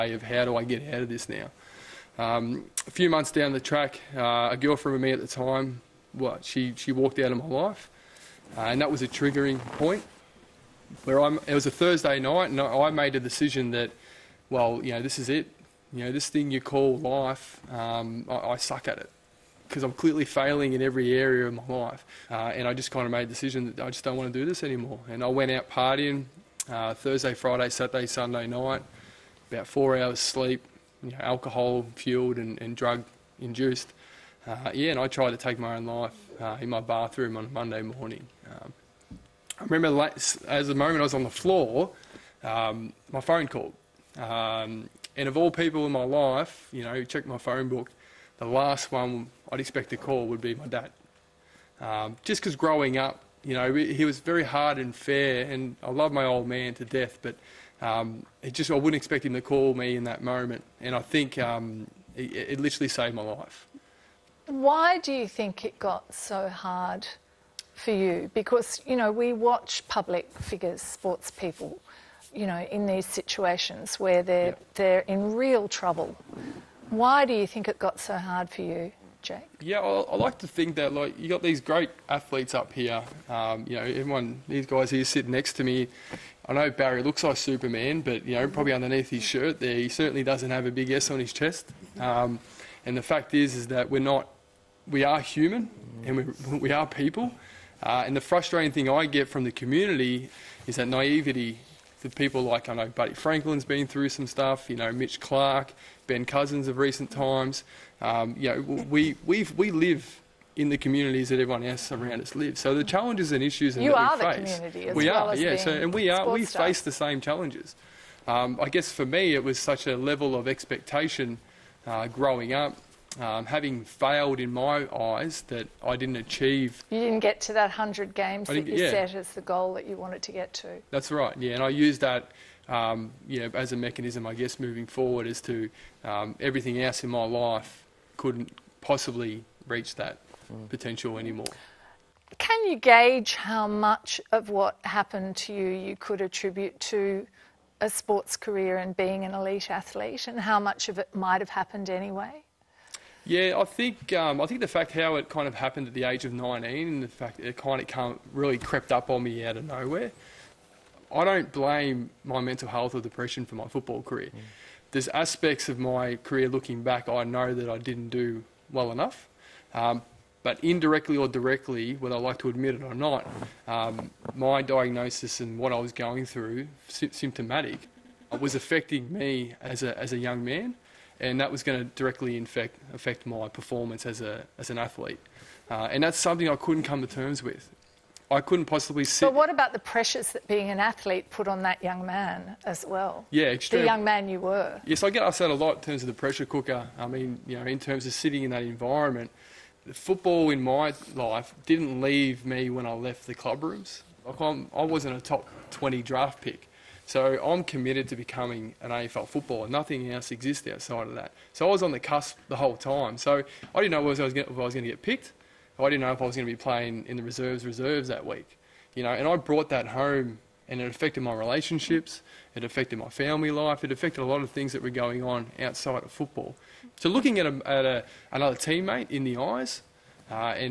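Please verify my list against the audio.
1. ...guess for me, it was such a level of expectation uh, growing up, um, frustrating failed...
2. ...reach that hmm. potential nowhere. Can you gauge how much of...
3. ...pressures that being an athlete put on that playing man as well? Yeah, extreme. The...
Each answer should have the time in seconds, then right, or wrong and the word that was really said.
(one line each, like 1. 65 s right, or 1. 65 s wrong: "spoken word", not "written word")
1. 118 s wrong: "having", not "frustrating"
2. 139 s wrong: "anymore", not "nowhere"
3. 189 s wrong: "young", not "playing".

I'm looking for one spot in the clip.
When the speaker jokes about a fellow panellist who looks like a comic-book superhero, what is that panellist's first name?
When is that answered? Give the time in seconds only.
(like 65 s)
86 s.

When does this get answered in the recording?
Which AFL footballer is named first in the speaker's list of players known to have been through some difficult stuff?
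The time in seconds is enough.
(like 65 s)
102 s.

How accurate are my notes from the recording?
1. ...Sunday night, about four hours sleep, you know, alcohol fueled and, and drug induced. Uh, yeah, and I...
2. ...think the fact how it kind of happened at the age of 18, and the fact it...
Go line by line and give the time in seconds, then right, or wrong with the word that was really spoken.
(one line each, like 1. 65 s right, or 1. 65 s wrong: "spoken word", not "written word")
1. 28 s right
2. 154 s wrong: "19", not "18".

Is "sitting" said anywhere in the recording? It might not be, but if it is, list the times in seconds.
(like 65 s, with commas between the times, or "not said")
85 s, 198 s.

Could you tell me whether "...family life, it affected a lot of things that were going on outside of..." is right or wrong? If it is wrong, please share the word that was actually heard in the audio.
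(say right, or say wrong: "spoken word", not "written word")
right.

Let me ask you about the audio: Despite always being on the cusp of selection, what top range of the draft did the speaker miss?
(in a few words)
Top 20.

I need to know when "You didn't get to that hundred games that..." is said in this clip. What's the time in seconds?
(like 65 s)
126 s.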